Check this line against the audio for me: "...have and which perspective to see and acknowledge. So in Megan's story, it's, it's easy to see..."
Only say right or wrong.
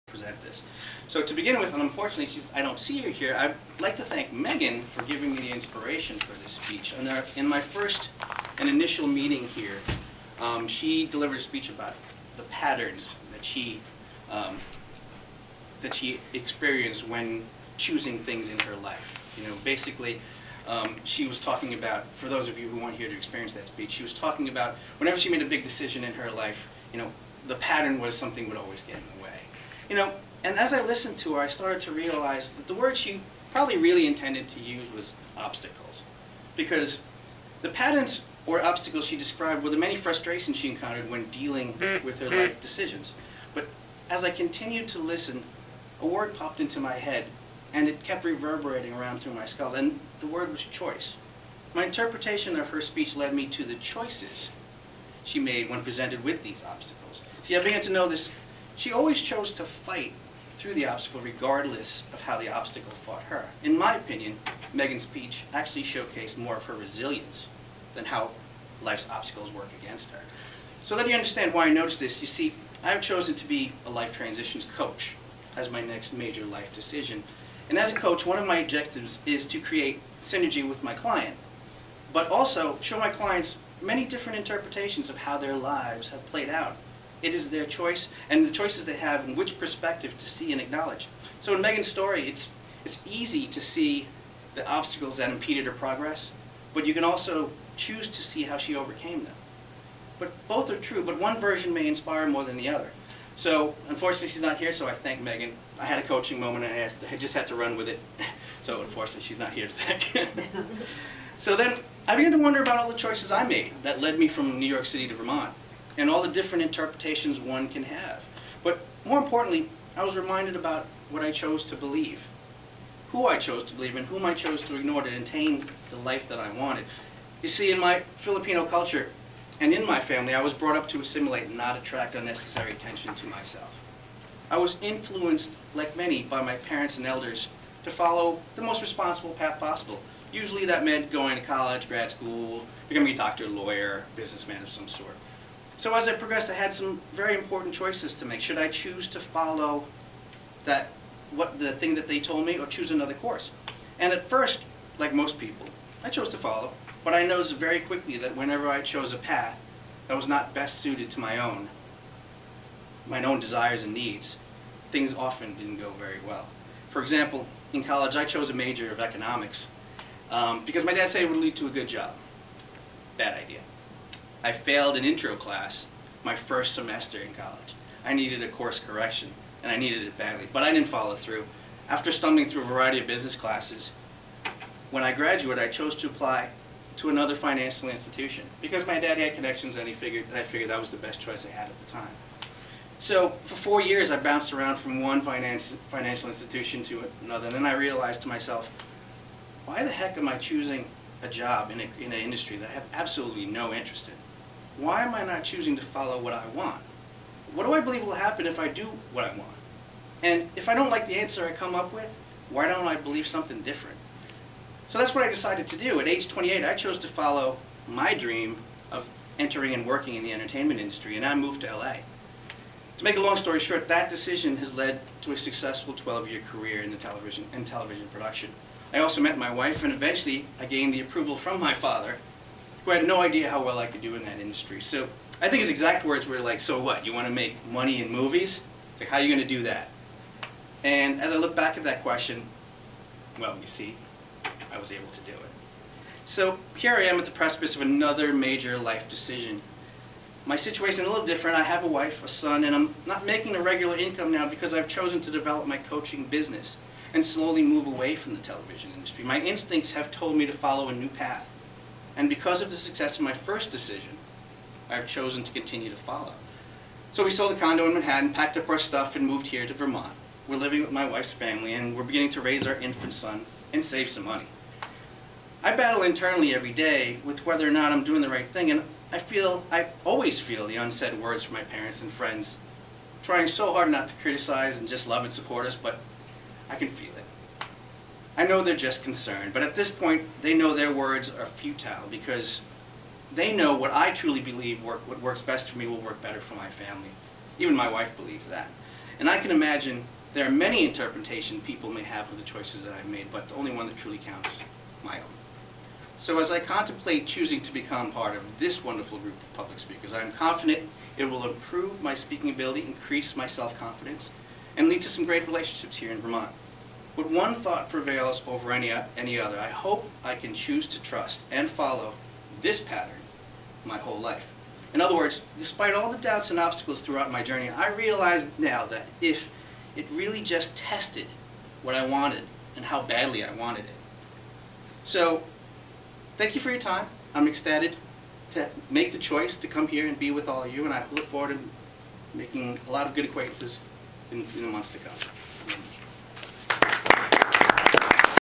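right.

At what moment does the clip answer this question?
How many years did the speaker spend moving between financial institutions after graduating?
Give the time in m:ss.
3:13.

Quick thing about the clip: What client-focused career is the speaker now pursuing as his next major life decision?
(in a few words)
Life transitions coach.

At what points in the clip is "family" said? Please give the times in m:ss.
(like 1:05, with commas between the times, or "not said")
2:09, 4:31, 4:56.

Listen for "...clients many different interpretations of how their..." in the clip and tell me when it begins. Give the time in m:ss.
1:23.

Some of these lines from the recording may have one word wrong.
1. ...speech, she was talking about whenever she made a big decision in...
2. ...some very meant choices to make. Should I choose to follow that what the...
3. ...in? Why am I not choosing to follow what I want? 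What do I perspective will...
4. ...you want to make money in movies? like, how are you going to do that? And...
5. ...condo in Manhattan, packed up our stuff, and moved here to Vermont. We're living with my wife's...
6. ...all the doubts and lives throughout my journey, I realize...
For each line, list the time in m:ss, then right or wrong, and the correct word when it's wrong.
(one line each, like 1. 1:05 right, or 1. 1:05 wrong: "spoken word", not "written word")
1. 0:23 right
2. 2:26 wrong: "important", not "meant"
3. 3:24 wrong: "believe", not "perspective"
4. 3:57 right
5. 4:27 right
6. 5:25 wrong: "obstacles", not "lives".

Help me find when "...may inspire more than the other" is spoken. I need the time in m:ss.
1:41.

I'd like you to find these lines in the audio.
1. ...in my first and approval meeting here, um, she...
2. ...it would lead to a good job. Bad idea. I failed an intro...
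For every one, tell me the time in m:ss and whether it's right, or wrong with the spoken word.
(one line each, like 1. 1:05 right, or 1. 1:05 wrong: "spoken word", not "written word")
1. 0:07 wrong: "initial", not "approval"
2. 2:51 right.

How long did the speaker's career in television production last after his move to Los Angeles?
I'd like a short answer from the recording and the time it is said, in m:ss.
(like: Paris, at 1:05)
12 years, at 3:45.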